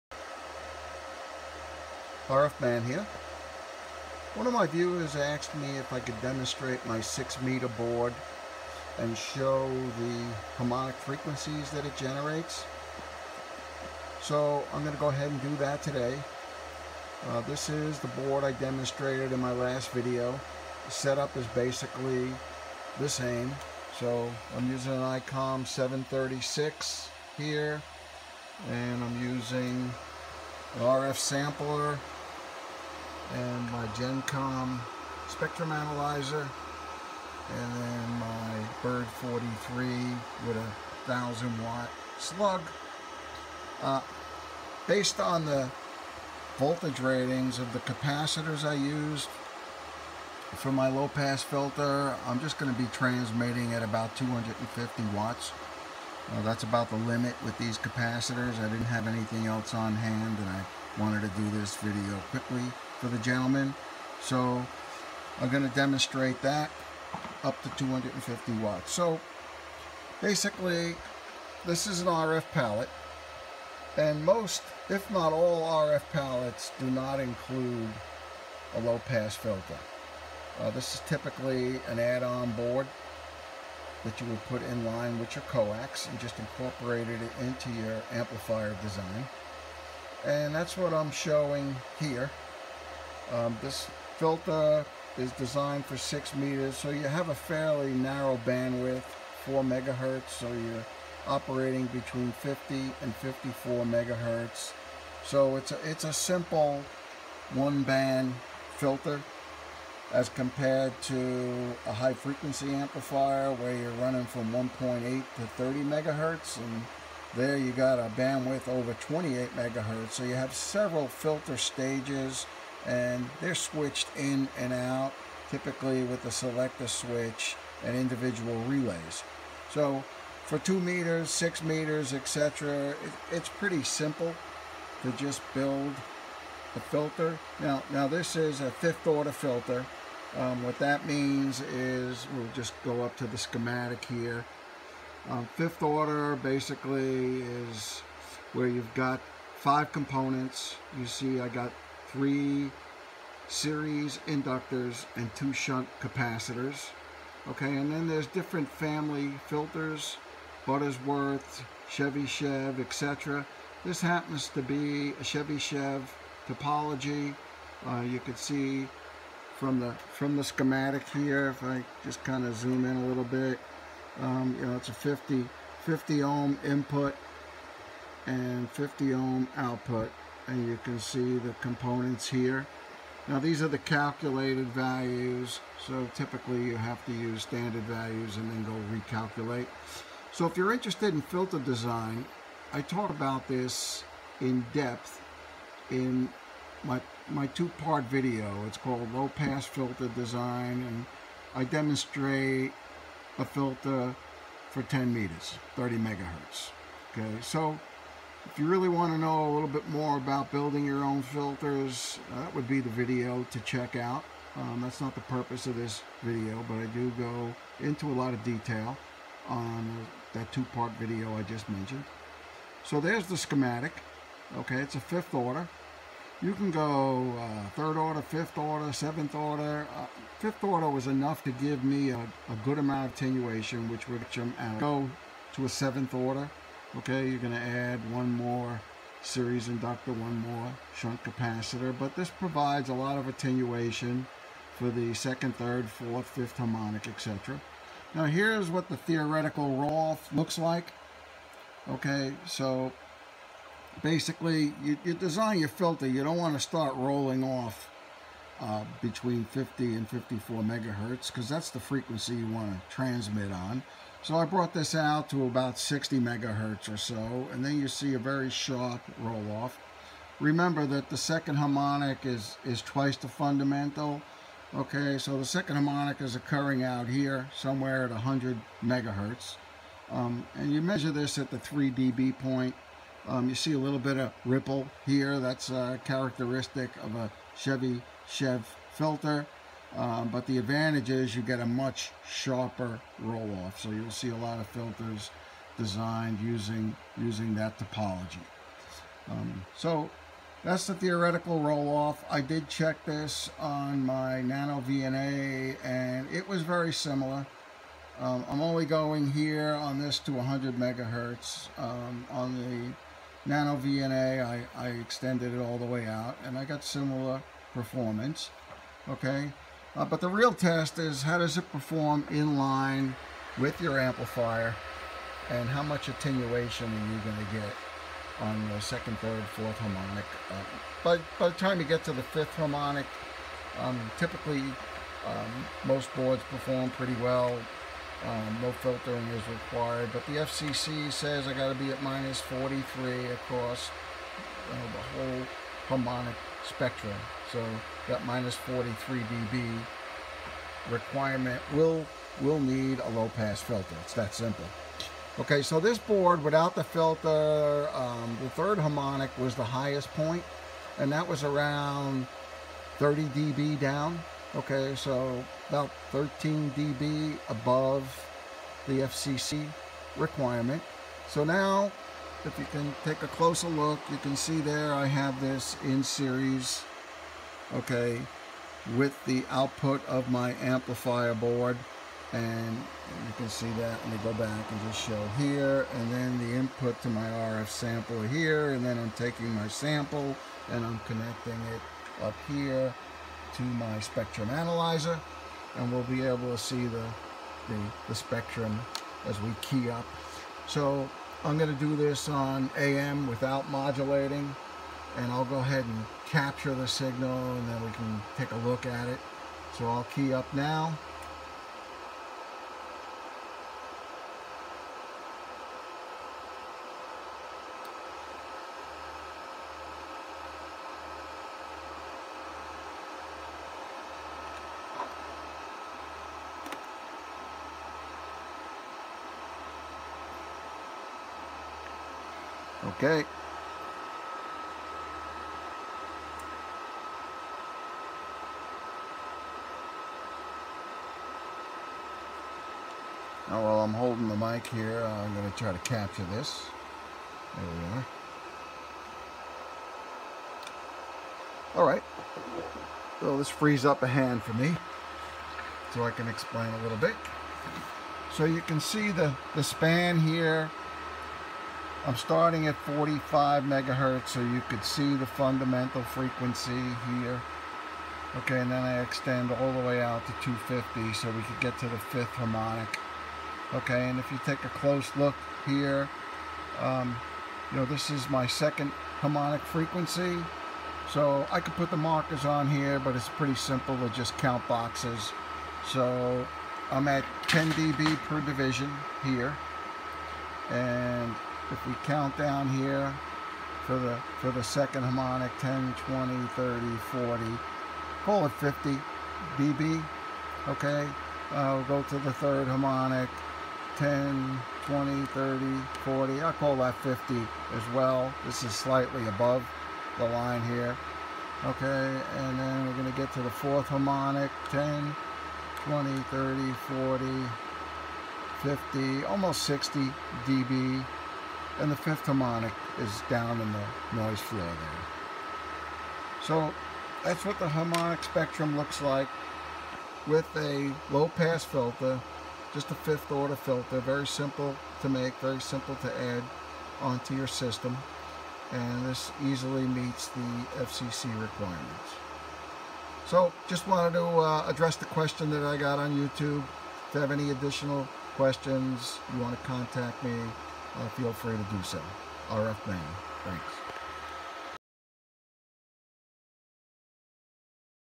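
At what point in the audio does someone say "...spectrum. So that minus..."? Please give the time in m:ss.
5:46.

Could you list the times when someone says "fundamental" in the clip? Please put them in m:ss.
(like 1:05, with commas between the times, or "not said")
4:33, 7:45.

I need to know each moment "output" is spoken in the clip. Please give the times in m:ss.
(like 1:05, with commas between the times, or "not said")
2:59, 6:19.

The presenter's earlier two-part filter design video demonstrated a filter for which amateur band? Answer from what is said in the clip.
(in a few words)
10 meters.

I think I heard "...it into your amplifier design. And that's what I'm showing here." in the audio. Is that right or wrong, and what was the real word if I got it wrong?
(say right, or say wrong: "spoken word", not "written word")
right.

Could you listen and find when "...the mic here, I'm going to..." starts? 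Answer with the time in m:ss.
7:24.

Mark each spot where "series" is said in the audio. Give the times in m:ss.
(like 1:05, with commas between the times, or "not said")
2:33, 3:59, 6:16.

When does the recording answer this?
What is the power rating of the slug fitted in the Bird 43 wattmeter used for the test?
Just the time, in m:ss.
0:41.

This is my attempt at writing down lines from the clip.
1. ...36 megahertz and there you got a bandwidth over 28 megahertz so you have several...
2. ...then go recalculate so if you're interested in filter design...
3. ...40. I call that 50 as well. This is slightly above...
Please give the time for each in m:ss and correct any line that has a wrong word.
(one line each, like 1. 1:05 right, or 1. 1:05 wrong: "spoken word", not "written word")
1. 1:55 wrong: "30", not "36"
2. 3:08 right
3. 8:26 right.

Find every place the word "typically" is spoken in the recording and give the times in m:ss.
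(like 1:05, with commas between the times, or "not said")
1:21, 2:05, 3:06, 5:34.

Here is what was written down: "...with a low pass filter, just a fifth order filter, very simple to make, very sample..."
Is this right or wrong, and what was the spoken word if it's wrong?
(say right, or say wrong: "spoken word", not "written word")
wrong: "simple", not "sample".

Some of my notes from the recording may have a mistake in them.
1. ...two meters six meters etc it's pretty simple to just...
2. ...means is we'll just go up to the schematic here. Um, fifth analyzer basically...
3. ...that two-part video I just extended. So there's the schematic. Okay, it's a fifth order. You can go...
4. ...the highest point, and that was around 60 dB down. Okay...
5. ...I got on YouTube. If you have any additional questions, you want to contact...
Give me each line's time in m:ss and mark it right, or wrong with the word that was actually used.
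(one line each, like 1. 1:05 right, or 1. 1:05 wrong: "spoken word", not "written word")
1. 2:10 right
2. 2:21 wrong: "order", not "analyzer"
3. 3:40 wrong: "mentioned", not "extended"
4. 5:59 wrong: "30", not "60"
5. 9:05 right.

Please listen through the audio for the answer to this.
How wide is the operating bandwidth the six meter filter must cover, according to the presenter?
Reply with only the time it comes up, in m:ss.
1:39.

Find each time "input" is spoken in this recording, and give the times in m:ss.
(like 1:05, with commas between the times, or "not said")
2:56, 6:26.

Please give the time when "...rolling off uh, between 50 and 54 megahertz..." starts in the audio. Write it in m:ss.
4:16.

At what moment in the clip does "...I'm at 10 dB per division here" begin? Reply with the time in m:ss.
8:06.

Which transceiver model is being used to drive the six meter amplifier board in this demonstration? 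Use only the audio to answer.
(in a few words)
ICOM 736.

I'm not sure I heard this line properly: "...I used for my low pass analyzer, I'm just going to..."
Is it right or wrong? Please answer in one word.
wrong.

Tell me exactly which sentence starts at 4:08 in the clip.
Now here's what the theoretical roll-off looks like.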